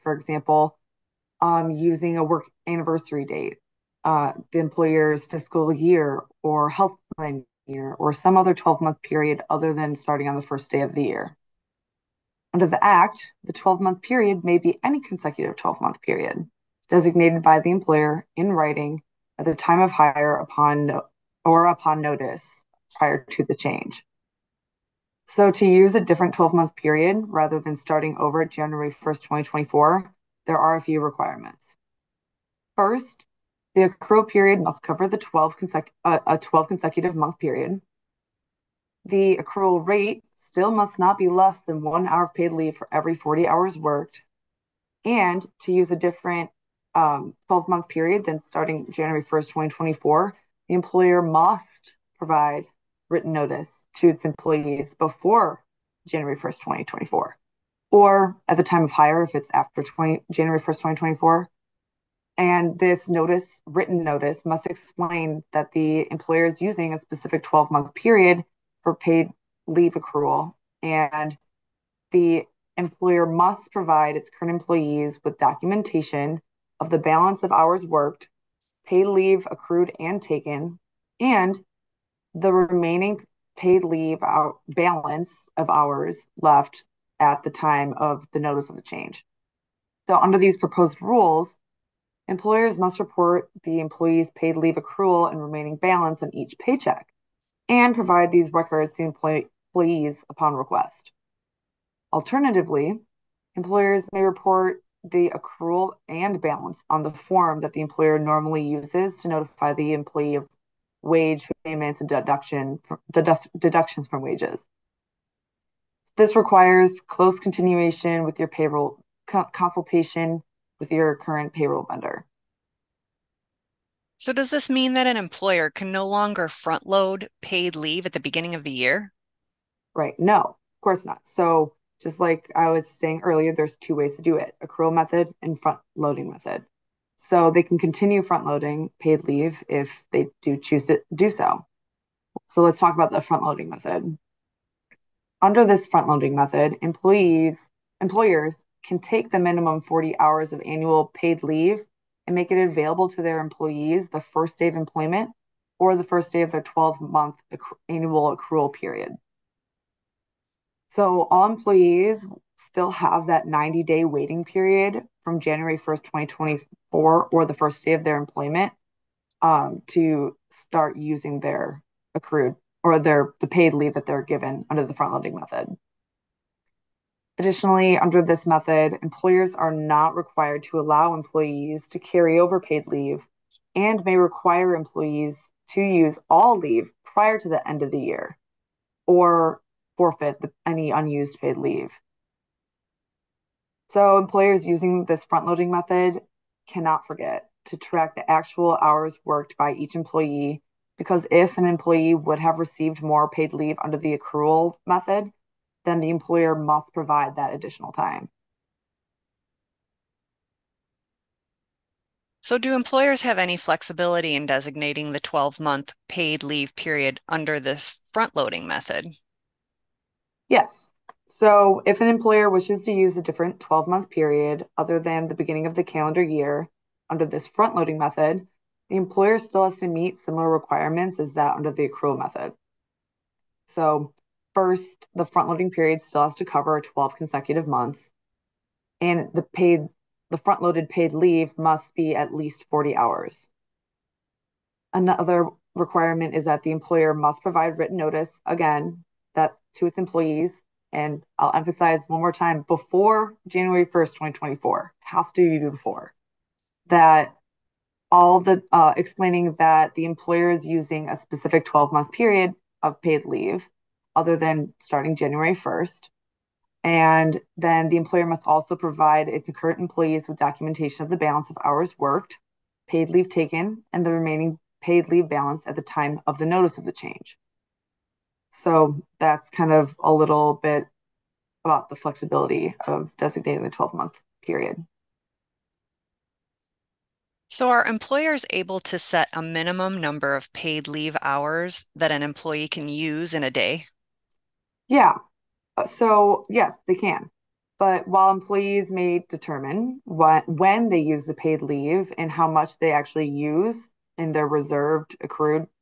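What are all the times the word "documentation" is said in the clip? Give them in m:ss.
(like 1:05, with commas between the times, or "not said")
1:15, 4:30.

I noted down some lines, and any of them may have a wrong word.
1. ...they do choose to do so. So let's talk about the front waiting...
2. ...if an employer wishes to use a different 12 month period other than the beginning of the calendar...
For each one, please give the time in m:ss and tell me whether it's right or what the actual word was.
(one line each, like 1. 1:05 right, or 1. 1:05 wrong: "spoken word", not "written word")
1. 2:20 wrong: "loading", not "waiting"
2. 3:41 right.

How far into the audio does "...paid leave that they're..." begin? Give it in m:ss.
2:53.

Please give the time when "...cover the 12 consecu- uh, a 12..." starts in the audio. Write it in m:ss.
0:34.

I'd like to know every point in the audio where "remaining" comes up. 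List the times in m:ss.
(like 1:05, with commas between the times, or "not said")
1:22, 1:35, 4:34.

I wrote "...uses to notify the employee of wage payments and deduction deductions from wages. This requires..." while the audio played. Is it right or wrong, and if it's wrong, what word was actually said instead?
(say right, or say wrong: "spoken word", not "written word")
right.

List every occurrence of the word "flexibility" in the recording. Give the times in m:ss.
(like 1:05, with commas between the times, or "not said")
3:33, 4:41.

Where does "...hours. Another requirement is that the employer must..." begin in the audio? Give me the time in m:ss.
4:02.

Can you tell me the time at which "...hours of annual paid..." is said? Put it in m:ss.
2:30.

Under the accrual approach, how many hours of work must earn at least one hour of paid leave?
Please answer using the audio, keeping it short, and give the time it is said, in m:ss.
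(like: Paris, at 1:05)
40, at 0:42.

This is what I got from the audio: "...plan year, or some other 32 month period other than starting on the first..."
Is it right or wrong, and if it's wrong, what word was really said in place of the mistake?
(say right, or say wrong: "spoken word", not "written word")
wrong: "12", not "32".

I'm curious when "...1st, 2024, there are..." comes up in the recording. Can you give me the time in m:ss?
0:28.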